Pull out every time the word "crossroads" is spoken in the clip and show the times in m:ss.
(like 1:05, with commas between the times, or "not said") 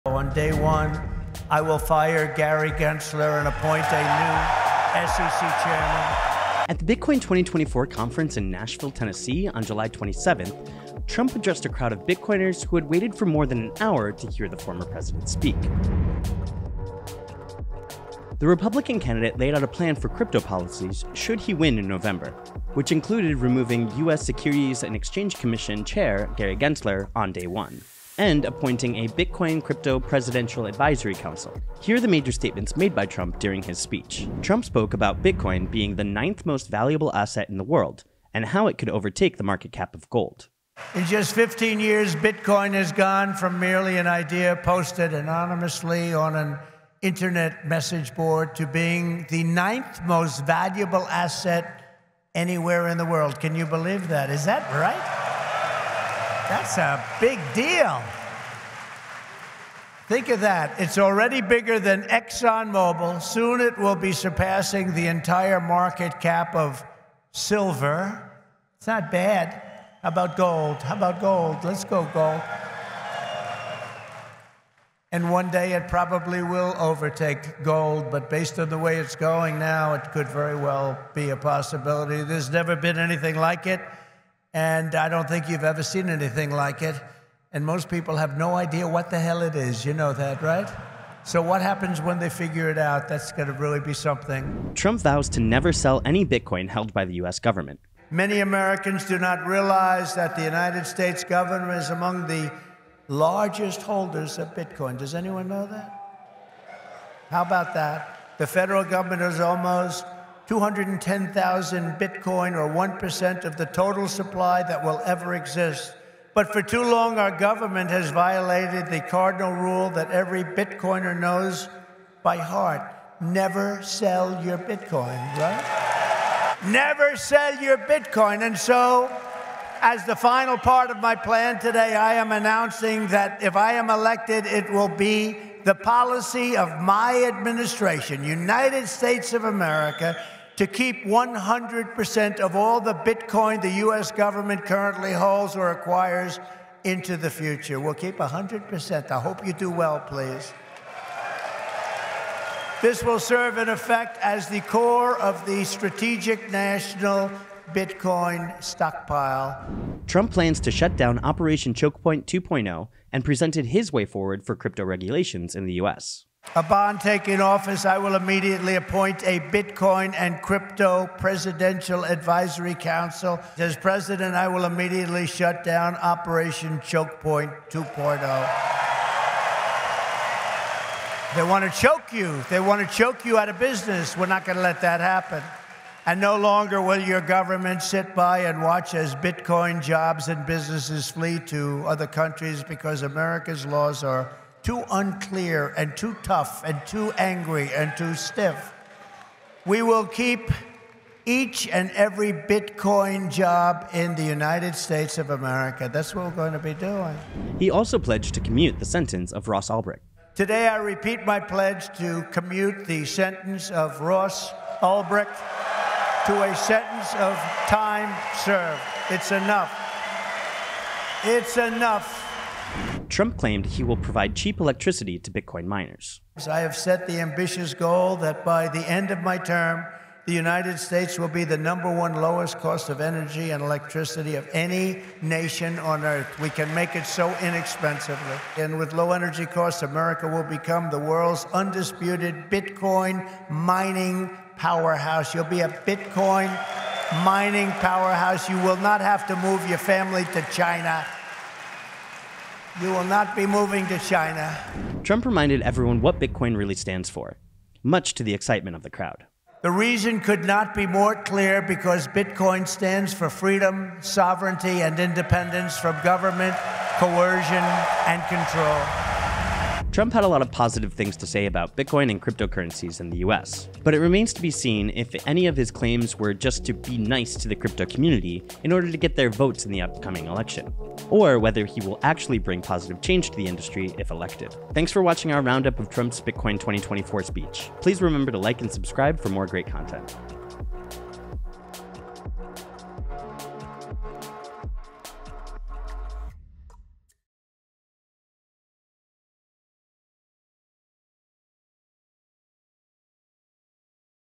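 not said.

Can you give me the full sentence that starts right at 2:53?
As president, I will immediately shut down Operation Choke Point 2.0.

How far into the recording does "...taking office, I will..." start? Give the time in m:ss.
2:46.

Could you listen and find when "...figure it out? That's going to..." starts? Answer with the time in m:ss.
1:32.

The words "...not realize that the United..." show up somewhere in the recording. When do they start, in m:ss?
1:39.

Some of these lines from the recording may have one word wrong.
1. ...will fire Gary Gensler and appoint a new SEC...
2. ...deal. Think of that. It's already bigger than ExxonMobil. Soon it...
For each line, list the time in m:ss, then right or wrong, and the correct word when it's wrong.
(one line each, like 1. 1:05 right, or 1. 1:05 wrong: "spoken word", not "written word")
1. 0:01 right
2. 0:57 right.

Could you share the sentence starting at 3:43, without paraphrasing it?
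Trump claimed he will provide cheap electricity to Bitcoin miners.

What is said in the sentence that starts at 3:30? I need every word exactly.
Today, I repeat my pledge to commute the sentence of Ross Ulbricht to a sentence of time served.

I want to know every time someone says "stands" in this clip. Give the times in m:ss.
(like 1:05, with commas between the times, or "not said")
4:16, 4:22.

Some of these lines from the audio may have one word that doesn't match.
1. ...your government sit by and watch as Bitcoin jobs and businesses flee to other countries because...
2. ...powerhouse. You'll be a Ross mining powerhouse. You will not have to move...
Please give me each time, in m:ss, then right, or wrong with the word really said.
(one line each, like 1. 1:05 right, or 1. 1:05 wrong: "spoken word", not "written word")
1. 3:07 right
2. 4:04 wrong: "Bitcoin", not "Ross".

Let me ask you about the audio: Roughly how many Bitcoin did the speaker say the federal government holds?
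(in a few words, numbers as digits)
210,000.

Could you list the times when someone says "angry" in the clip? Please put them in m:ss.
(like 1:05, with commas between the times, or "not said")
3:17.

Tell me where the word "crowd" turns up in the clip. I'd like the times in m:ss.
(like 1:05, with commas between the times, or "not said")
0:11, 4:18.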